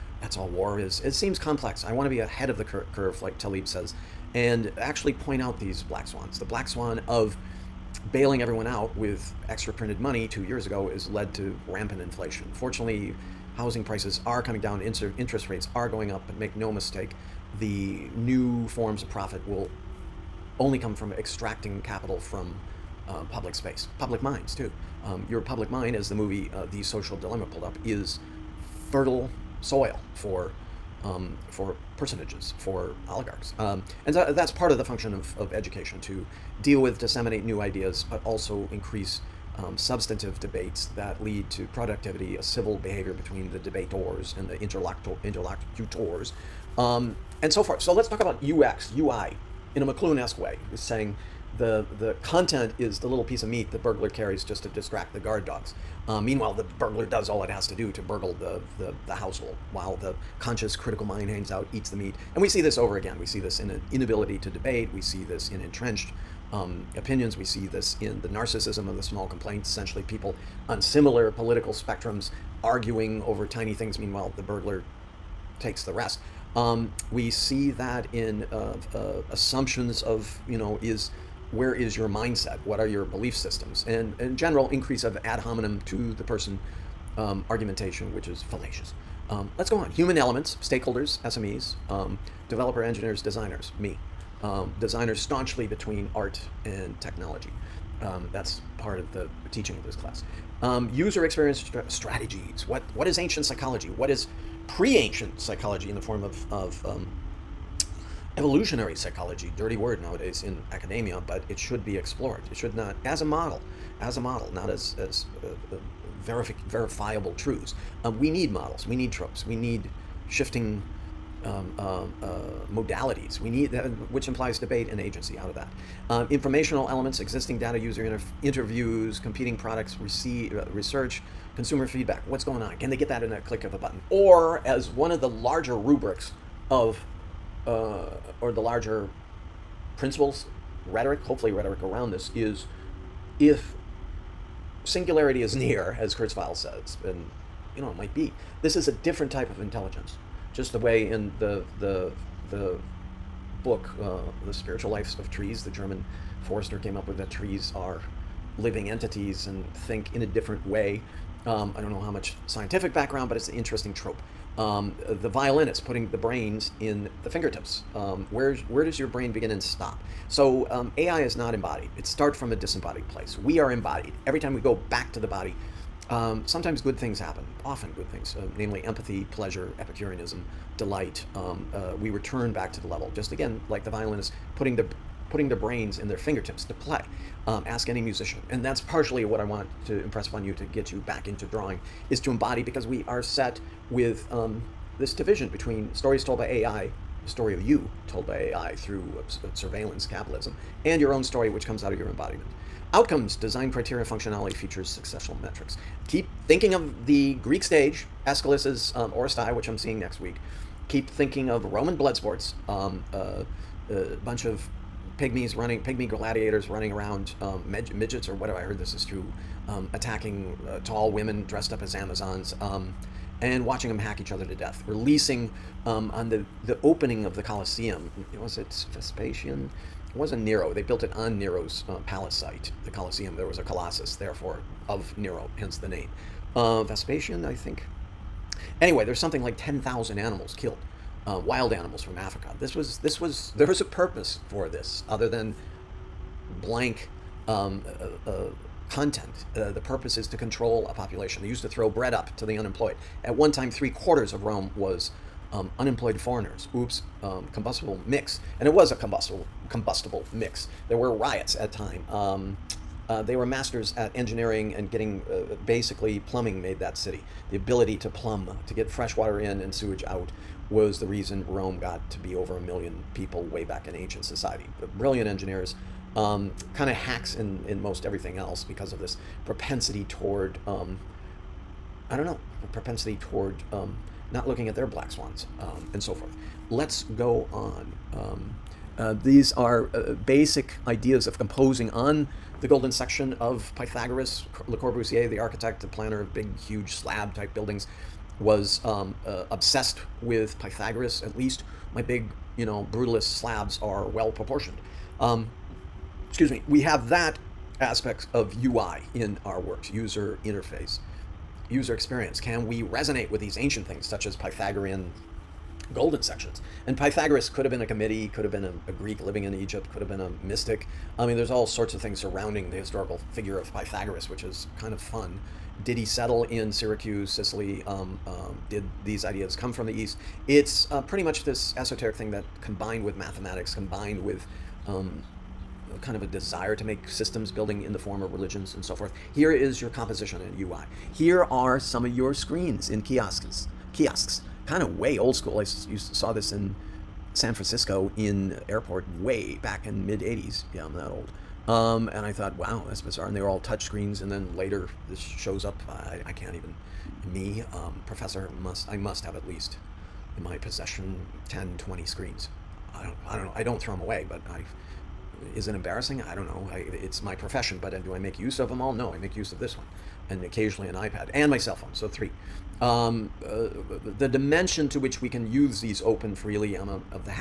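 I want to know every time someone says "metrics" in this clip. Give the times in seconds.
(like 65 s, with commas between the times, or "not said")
205 s.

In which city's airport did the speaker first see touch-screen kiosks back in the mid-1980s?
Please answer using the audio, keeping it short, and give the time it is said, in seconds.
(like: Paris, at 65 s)
San Francisco, at 347 s.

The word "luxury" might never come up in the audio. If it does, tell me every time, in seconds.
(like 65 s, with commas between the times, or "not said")
not said.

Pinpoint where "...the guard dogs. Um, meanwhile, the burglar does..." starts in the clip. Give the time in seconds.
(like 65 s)
55 s.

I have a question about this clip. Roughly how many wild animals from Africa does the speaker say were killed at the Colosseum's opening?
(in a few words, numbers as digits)
10,000.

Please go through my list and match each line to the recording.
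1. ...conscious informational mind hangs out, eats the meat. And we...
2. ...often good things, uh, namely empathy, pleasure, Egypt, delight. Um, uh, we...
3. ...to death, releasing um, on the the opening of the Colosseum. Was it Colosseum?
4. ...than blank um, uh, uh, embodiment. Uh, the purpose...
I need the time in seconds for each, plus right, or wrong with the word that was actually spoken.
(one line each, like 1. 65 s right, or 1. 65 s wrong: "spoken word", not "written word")
1. 60 s wrong: "critical", not "informational"
2. 177 s wrong: "Epicureanism", not "Egypt"
3. 224 s wrong: "Vespasian", not "Colosseum"
4. 245 s wrong: "content", not "embodiment".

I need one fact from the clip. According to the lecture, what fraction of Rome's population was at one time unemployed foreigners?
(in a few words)
three quarters.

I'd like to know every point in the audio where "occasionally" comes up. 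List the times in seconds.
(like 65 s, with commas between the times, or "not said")
370 s.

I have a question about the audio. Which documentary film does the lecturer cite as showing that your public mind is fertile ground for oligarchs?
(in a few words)
The Social Dilemma.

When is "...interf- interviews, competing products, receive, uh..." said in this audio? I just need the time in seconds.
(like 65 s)
128 s.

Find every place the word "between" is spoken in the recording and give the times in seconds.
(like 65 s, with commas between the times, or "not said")
43 s, 95 s, 195 s.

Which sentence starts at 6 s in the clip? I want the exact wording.
The black swan of bailing everyone out with extra printed money two years ago has led to rampant inflation.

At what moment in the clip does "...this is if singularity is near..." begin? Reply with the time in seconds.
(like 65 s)
142 s.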